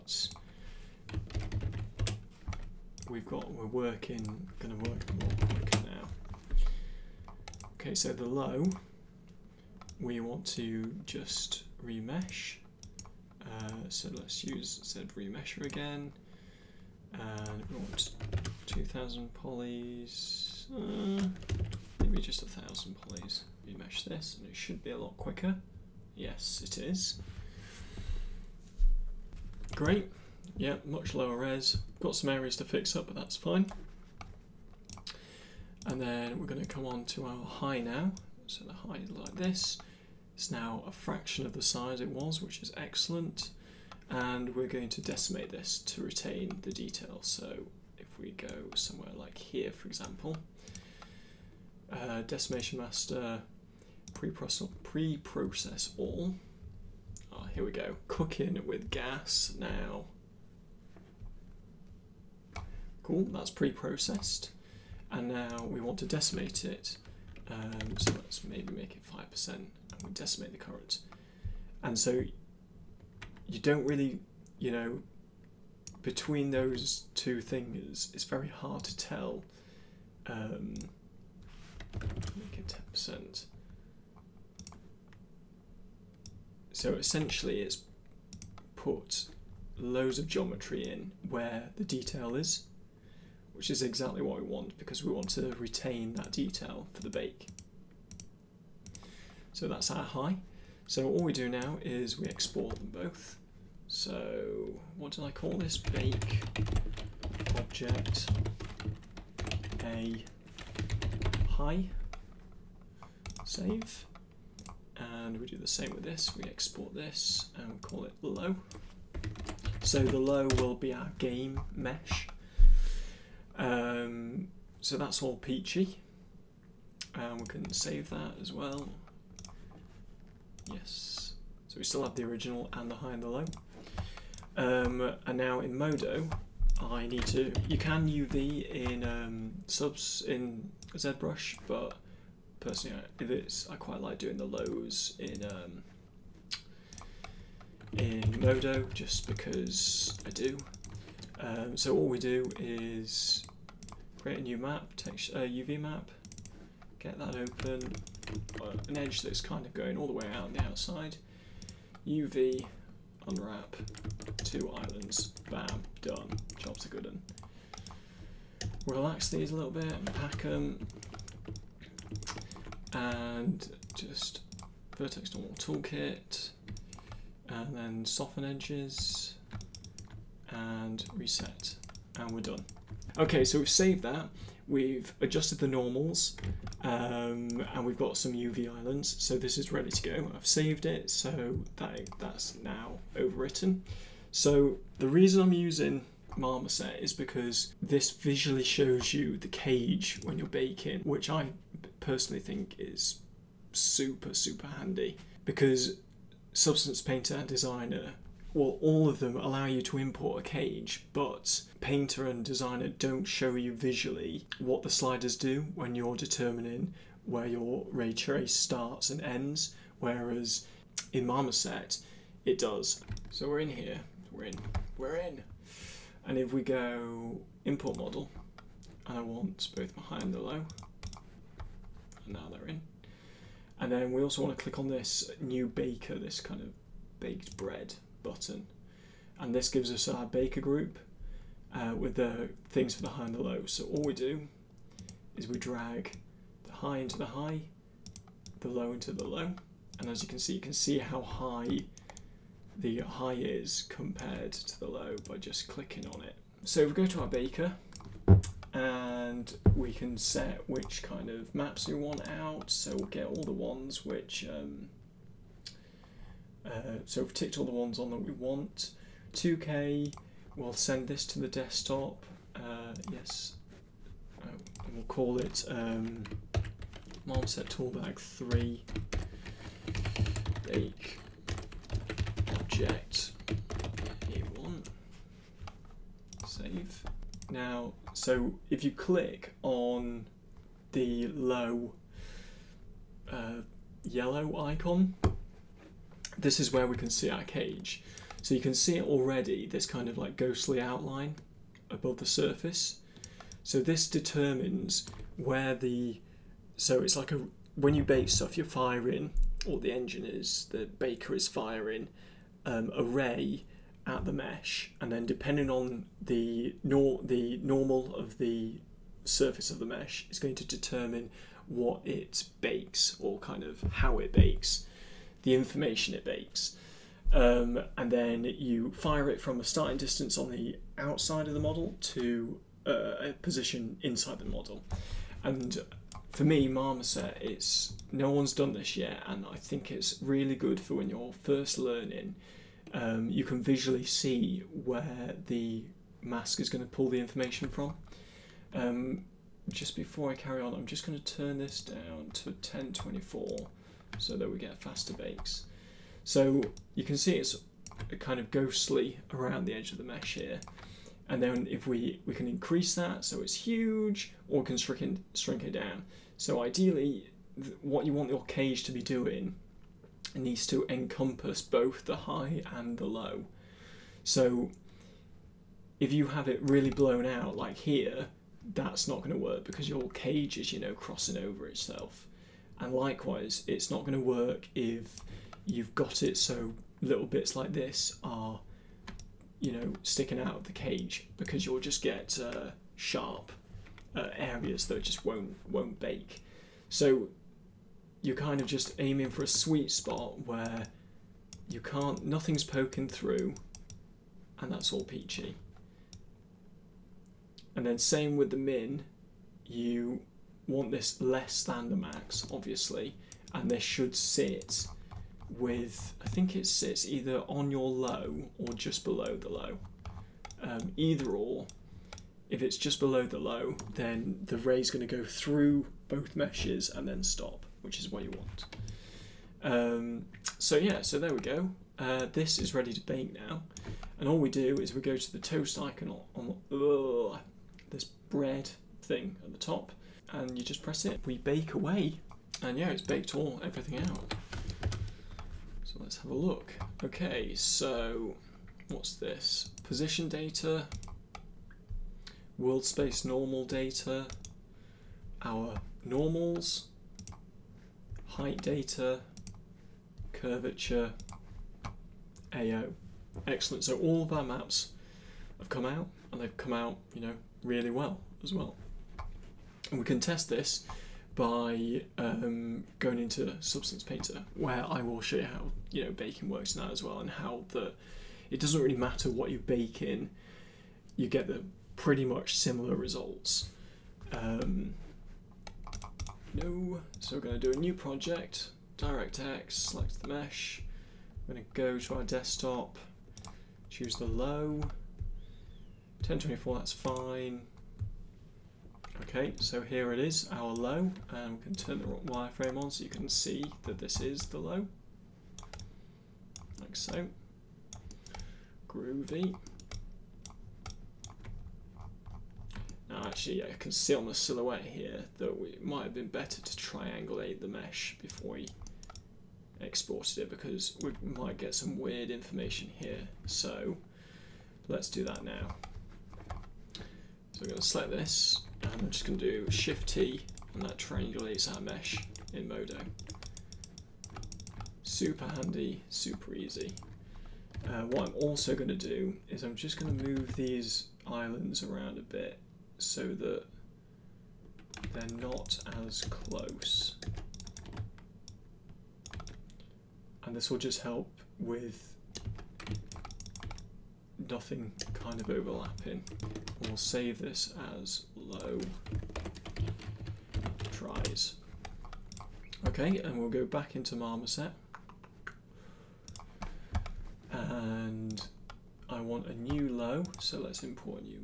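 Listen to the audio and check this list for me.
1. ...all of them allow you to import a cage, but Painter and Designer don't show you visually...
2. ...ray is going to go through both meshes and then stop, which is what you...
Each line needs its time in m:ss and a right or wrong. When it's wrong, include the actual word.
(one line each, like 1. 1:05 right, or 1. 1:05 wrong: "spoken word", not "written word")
1. 3:28 right
2. 7:04 right.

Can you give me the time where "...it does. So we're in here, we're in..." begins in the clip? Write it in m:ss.
3:42.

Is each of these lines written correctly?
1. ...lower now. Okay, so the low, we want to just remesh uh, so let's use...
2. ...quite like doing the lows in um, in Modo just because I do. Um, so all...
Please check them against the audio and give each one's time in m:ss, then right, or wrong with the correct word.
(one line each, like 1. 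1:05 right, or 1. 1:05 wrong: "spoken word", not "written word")
1. 0:05 wrong: "quicker", not "lower"
2. 2:23 right.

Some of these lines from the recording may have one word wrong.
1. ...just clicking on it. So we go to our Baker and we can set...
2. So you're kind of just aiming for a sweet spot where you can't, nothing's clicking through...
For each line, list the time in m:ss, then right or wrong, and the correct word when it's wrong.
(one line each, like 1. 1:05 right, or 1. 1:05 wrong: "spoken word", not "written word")
1. 4:15 right
2. 6:36 wrong: "poking", not "clicking".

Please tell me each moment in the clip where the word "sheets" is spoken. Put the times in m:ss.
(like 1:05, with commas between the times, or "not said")
not said.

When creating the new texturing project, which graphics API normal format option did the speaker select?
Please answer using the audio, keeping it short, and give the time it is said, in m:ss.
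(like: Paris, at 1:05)
DirectX, at 8:08.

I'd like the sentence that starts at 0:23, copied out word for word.
Remesh this, and it should be a lot quicker.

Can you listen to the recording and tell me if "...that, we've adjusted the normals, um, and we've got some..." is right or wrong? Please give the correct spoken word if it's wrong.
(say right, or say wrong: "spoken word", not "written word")
right.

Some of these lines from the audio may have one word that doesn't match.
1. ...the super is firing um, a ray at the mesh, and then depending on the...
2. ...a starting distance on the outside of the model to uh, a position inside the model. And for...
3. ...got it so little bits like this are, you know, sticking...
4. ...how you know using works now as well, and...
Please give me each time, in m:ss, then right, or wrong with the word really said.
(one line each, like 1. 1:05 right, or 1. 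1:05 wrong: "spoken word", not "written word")
1. 5:10 wrong: "baker", not "super"
2. 5:29 right
3. 6:25 right
4. 7:55 wrong: "baking", not "using".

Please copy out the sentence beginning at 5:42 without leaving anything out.
Um, you can visually see where the mask is going to pull the information from.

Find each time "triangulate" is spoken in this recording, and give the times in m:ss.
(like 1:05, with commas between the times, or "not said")
8:36, 8:50.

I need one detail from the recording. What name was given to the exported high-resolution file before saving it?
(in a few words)
Bake object a high.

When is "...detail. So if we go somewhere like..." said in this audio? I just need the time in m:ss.
0:46.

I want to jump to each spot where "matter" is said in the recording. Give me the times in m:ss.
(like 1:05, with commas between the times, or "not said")
7:58.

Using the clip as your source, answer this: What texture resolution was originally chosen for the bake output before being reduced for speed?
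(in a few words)
2K.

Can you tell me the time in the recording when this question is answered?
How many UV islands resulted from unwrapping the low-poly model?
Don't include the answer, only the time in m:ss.
2:44.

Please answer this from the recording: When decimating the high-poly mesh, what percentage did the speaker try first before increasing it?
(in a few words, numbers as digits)
5%.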